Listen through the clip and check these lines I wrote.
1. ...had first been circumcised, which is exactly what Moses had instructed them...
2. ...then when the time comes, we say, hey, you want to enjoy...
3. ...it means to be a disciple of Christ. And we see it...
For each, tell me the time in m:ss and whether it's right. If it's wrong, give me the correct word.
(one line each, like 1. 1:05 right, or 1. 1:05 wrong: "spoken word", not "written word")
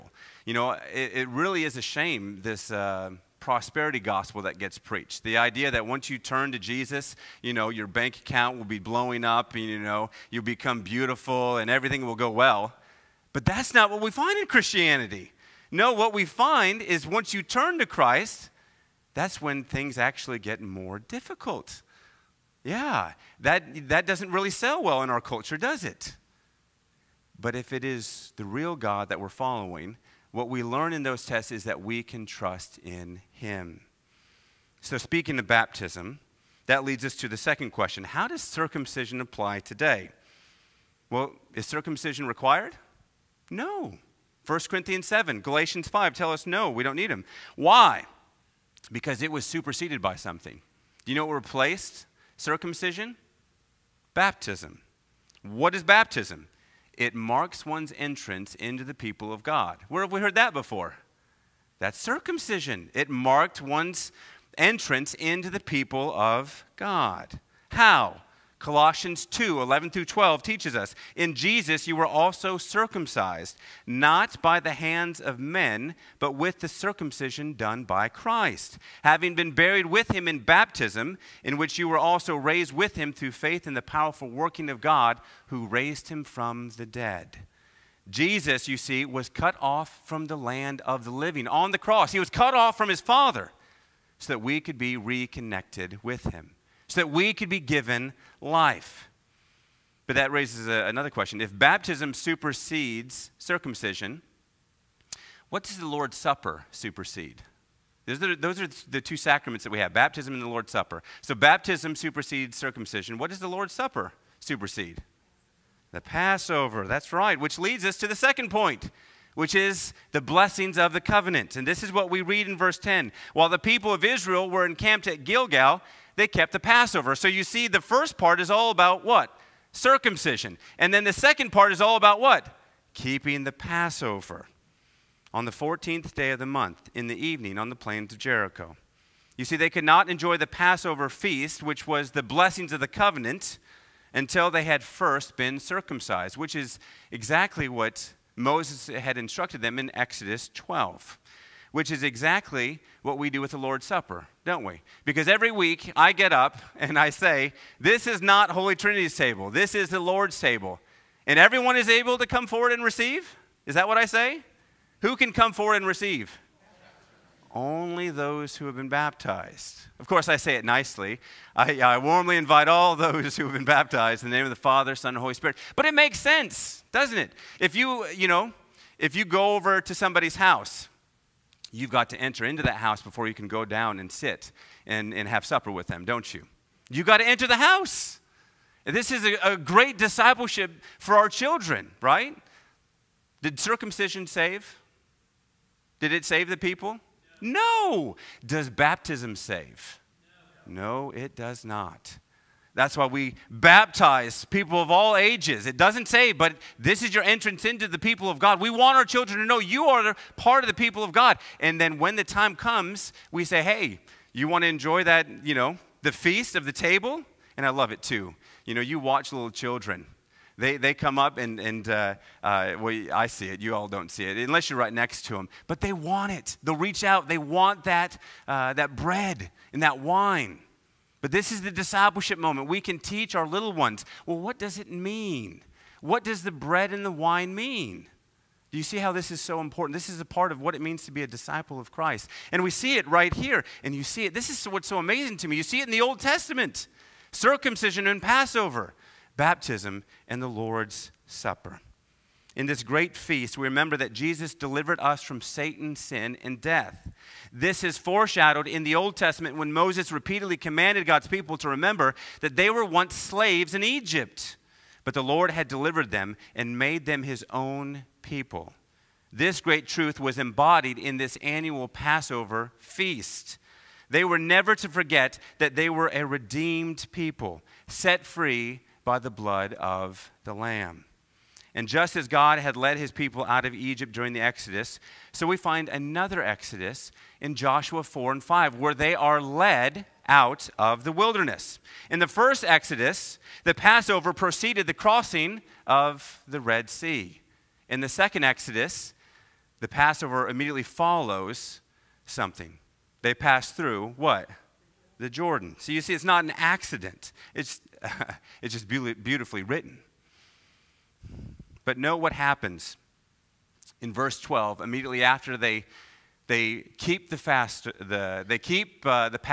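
1. 2:24 right
2. 3:31 right
3. 4:00 right.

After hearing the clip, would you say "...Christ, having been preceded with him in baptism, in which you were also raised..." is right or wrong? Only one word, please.
wrong.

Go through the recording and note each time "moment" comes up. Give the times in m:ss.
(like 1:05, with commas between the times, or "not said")
3:52.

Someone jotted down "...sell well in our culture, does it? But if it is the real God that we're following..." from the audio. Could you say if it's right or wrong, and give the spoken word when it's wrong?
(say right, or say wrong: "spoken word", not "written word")
right.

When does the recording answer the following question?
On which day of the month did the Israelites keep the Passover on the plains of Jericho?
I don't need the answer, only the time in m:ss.
2:15.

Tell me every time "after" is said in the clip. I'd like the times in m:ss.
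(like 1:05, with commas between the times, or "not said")
5:15.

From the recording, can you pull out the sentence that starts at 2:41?
And everyone is able to come forward and receive?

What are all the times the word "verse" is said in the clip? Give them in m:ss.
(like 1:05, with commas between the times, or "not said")
2:02, 5:14.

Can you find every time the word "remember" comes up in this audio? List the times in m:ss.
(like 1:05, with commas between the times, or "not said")
4:13, 4:21.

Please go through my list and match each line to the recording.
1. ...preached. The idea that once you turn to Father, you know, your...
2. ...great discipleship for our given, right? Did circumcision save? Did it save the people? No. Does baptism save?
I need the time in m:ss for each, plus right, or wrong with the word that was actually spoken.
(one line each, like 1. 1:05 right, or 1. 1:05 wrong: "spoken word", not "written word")
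1. 0:04 wrong: "Jesus", not "Father"
2. 3:09 wrong: "children", not "given".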